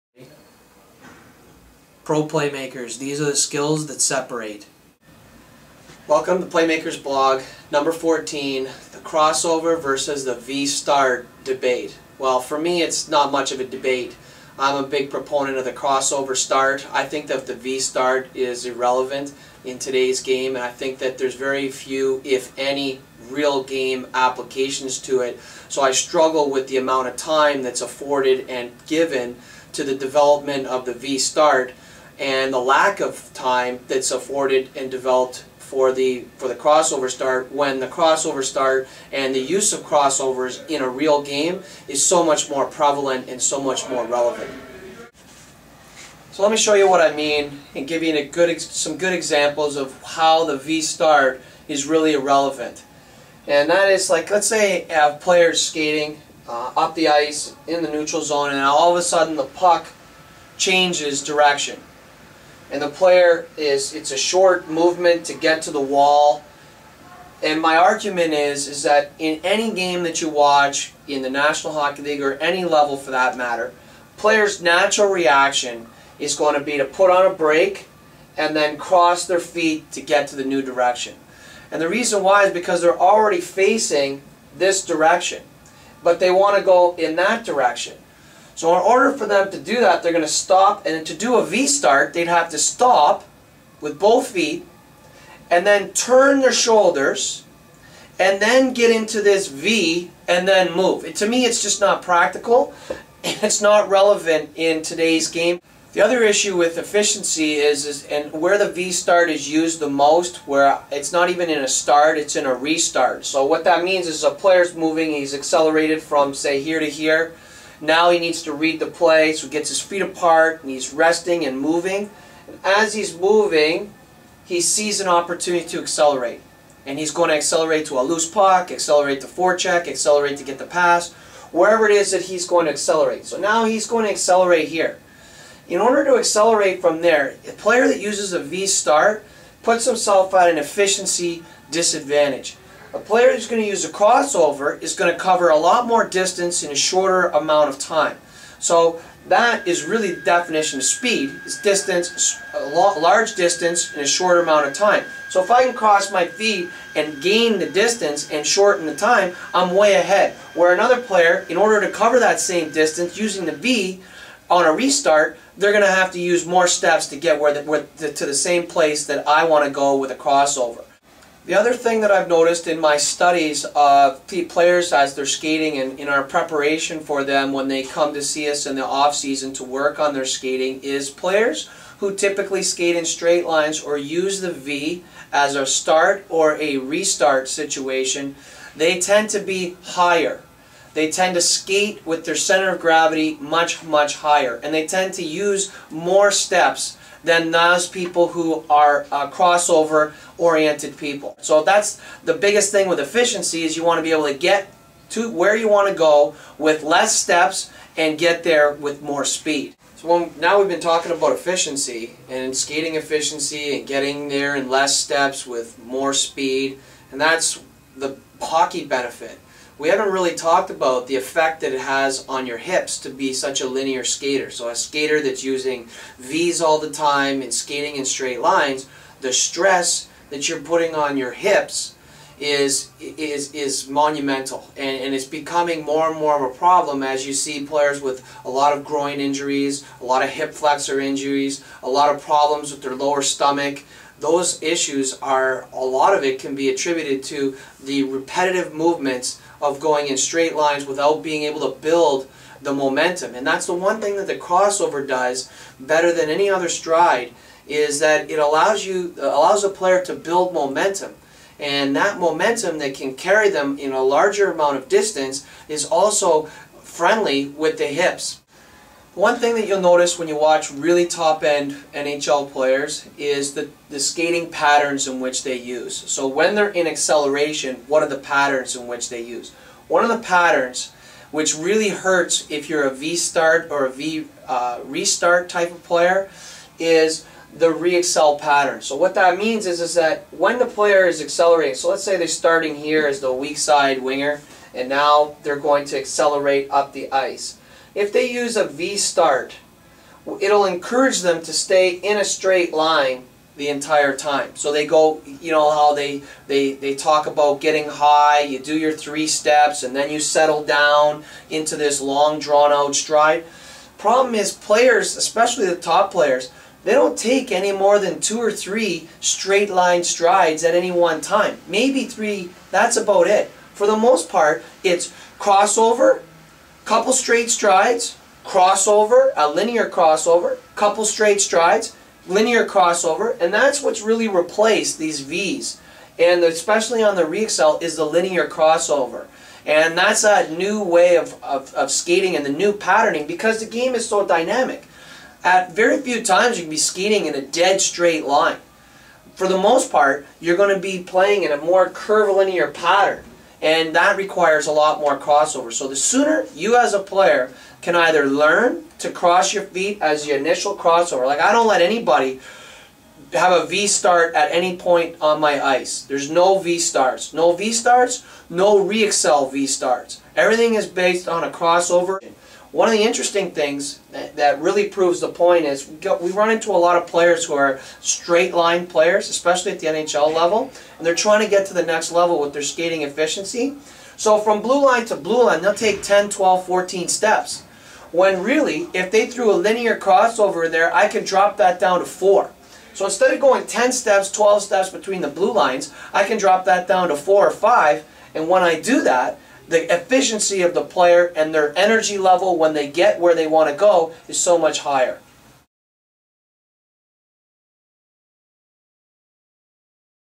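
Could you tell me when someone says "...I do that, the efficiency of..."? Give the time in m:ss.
6:38.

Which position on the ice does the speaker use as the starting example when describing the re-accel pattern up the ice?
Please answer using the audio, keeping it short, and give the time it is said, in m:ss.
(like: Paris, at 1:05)
weak side winger, at 4:53.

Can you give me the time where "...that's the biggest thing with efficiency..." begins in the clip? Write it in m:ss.
3:21.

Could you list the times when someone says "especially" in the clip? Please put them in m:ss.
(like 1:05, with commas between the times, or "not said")
5:15, 5:36, 6:19.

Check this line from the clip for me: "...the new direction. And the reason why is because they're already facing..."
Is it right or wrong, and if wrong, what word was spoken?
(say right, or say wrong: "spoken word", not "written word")
right.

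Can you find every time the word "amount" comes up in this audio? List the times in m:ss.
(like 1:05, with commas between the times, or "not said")
0:26, 2:27, 2:34, 4:24.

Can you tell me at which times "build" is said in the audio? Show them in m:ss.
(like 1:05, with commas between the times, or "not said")
4:11, 4:20.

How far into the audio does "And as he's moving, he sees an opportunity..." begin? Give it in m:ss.
2:02.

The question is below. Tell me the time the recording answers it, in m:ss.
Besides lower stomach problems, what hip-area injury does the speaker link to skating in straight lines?
3:58.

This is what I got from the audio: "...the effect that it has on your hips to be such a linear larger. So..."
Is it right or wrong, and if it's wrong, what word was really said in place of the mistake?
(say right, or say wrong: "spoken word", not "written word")
wrong: "skater", not "larger".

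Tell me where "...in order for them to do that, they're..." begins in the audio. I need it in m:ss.
1:28.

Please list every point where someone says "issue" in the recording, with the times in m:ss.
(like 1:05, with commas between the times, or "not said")
1:46, 4:04.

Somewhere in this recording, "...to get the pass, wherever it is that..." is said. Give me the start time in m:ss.
2:10.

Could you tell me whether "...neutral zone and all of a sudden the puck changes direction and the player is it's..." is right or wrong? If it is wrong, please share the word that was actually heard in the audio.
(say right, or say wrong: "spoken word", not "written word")
right.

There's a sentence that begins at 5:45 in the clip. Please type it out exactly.
At very few times you can be skating in a dead straight line.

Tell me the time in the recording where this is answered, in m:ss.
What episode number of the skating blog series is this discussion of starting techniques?
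0:07.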